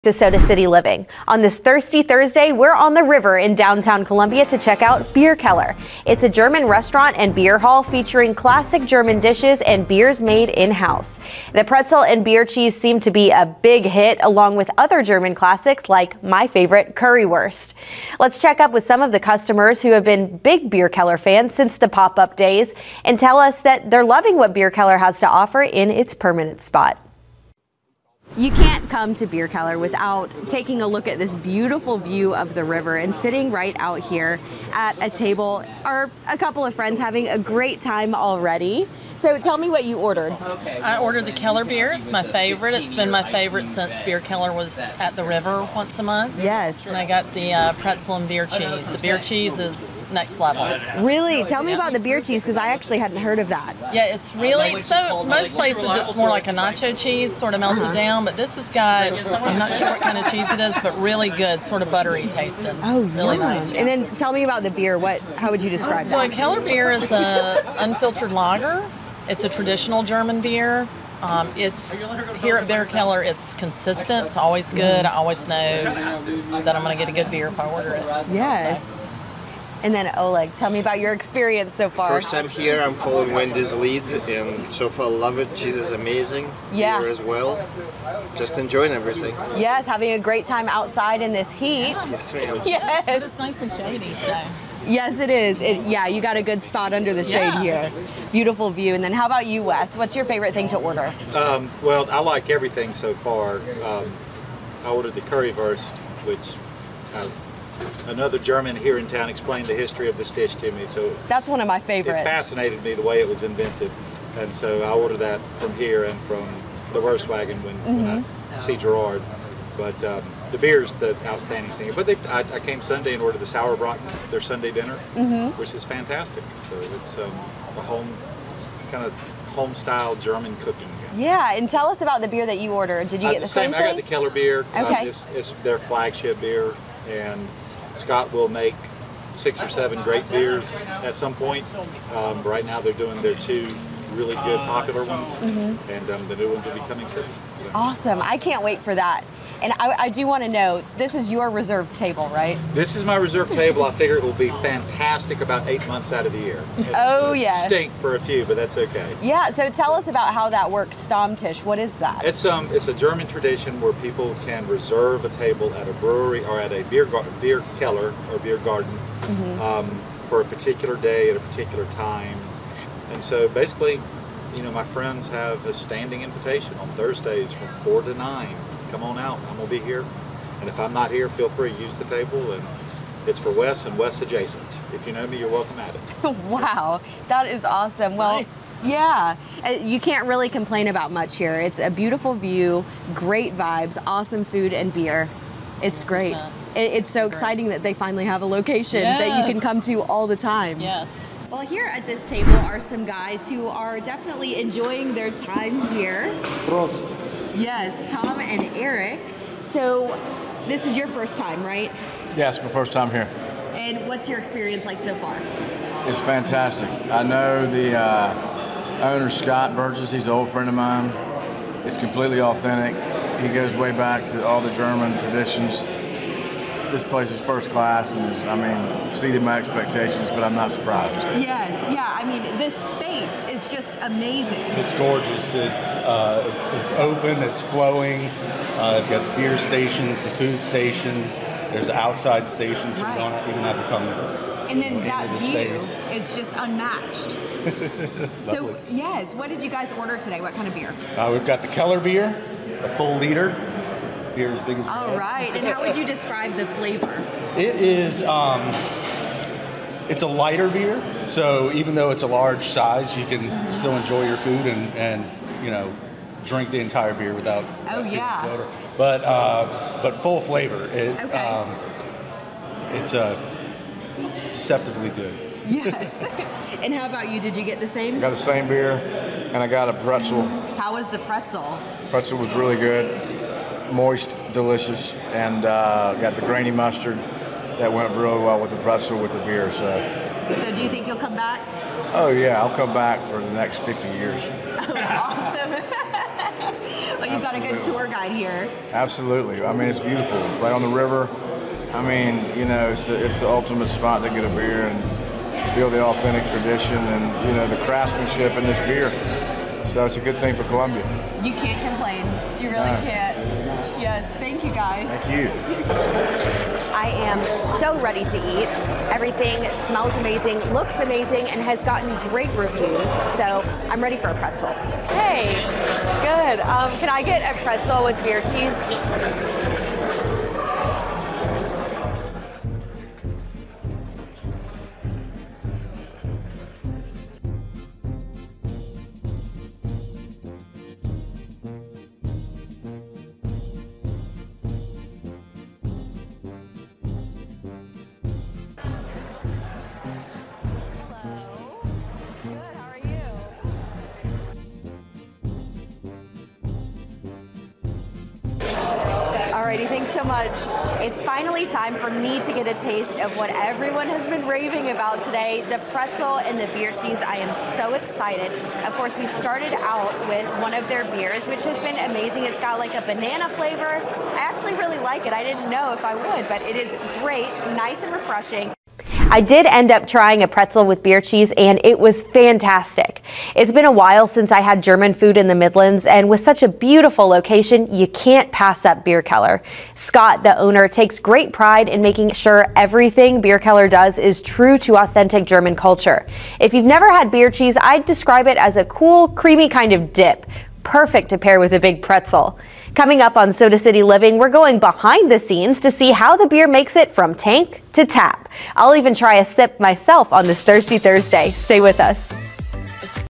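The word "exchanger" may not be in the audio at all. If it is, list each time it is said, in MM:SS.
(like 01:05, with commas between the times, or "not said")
not said.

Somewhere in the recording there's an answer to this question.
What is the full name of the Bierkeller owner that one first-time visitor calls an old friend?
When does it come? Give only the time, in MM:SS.
03:39.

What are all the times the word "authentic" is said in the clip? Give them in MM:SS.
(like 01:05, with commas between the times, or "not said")
03:42, 05:06, 06:34.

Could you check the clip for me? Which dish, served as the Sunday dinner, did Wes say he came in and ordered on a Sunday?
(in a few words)
Sauerbraten.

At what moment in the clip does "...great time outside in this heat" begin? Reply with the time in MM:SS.
01:30.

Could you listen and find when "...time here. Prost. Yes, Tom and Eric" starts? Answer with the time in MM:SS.
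03:25.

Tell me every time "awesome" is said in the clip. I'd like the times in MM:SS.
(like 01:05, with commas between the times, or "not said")
02:27, 03:07, 03:14, 04:54.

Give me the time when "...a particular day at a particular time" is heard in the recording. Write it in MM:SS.
02:50.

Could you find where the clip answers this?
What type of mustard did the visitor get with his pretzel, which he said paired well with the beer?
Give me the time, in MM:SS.
04:46.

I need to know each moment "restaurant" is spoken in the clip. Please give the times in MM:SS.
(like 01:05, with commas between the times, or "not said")
00:06.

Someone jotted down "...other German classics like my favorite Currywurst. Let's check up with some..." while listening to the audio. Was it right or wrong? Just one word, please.
right.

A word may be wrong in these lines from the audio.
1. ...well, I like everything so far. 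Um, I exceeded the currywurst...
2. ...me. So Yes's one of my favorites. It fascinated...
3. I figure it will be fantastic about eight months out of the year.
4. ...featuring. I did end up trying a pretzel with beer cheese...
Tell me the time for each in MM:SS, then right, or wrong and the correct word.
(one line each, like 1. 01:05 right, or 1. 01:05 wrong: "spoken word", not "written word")
1. 01:41 wrong: "ordered", not "exceeded"
2. 01:50 wrong: "That", not "Yes"
3. 02:33 right
4. 06:18 wrong: "refreshing", not "featuring".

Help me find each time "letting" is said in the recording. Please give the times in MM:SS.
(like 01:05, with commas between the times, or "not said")
not said.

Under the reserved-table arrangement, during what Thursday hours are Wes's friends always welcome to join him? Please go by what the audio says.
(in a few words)
4 to 9.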